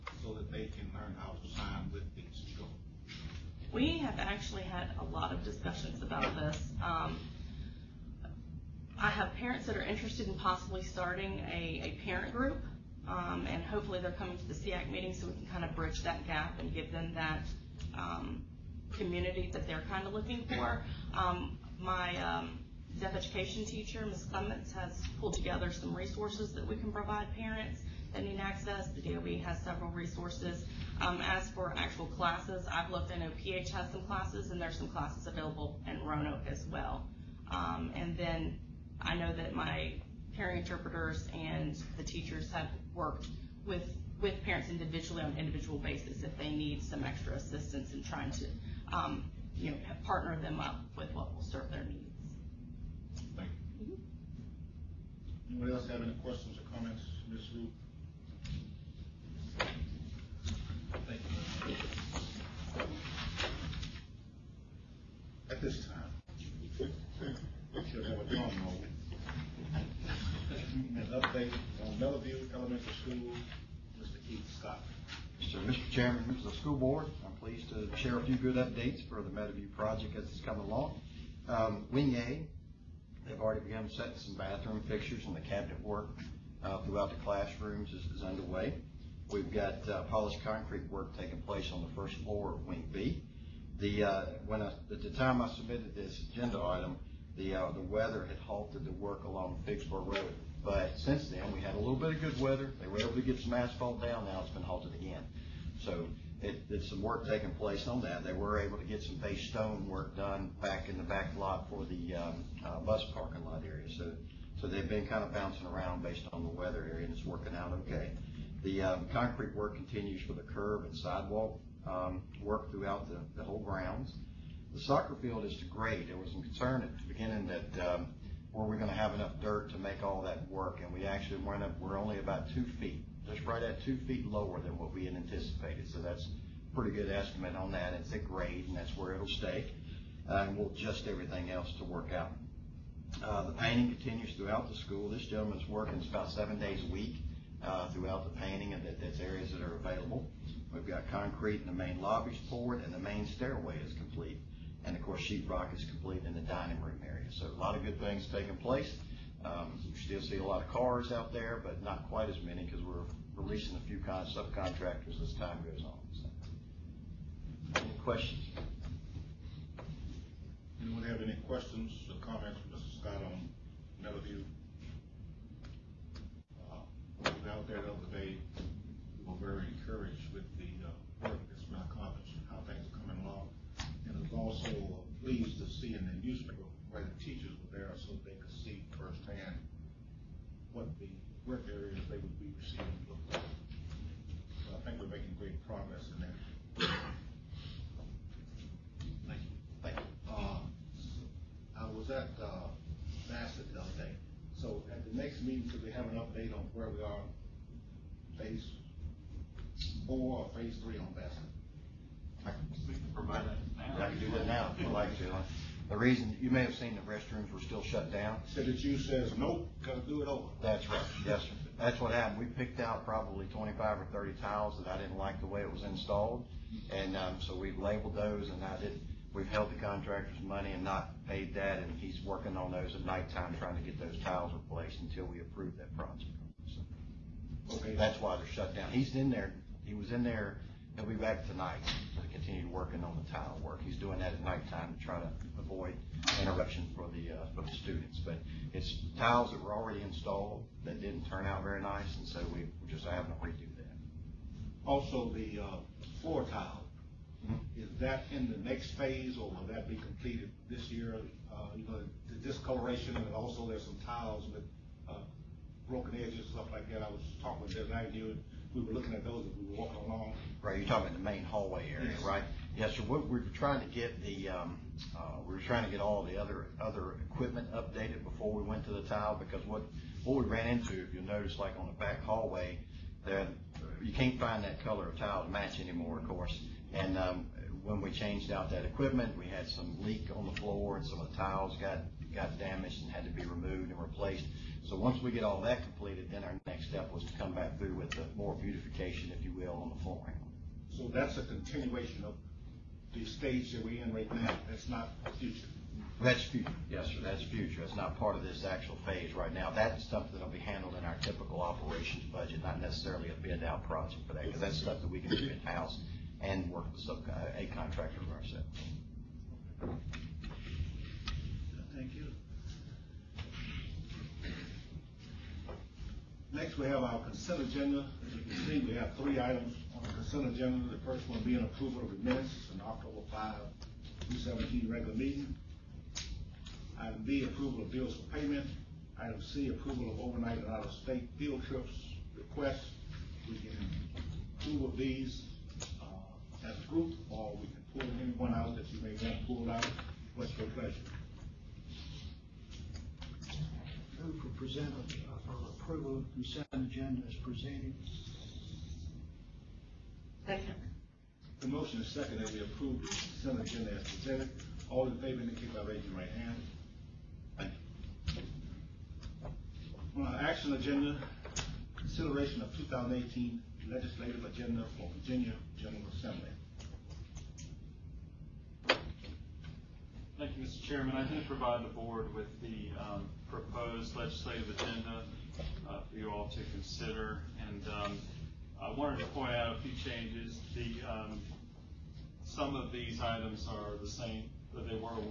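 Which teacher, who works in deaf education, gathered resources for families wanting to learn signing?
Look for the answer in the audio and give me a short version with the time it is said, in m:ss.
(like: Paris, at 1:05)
Ms. Clements, at 0:24.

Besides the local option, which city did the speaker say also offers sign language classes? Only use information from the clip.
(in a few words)
Roanoke.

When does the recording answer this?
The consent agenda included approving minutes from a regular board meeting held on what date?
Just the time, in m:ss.
5:32.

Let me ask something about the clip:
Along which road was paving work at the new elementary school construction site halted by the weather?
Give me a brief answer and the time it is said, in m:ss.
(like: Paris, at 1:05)
Figsboro Road, at 1:39.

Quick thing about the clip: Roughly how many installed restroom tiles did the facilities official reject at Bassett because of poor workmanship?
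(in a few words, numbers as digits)
25 or 30.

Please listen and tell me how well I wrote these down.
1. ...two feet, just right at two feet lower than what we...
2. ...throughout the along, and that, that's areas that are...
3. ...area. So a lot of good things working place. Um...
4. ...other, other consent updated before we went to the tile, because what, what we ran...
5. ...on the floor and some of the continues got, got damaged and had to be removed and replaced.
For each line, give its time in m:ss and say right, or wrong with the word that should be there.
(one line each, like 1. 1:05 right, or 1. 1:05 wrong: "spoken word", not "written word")
1. 2:12 right
2. 2:27 wrong: "painting", not "along"
3. 2:37 wrong: "taking", not "working"
4. 4:36 wrong: "equipment", not "consent"
5. 4:50 wrong: "tiles", not "continues".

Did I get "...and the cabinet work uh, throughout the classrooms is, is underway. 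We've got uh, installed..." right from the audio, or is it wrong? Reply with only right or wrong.
wrong.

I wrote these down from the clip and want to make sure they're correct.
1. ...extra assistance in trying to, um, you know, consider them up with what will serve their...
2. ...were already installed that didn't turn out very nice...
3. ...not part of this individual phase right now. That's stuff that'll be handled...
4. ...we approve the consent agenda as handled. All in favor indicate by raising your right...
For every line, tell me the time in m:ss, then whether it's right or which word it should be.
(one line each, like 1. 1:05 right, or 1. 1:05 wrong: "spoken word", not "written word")
1. 0:47 wrong: "partner", not "consider"
2. 4:09 right
3. 5:07 wrong: "actual", not "individual"
4. 6:02 wrong: "presented", not "handled".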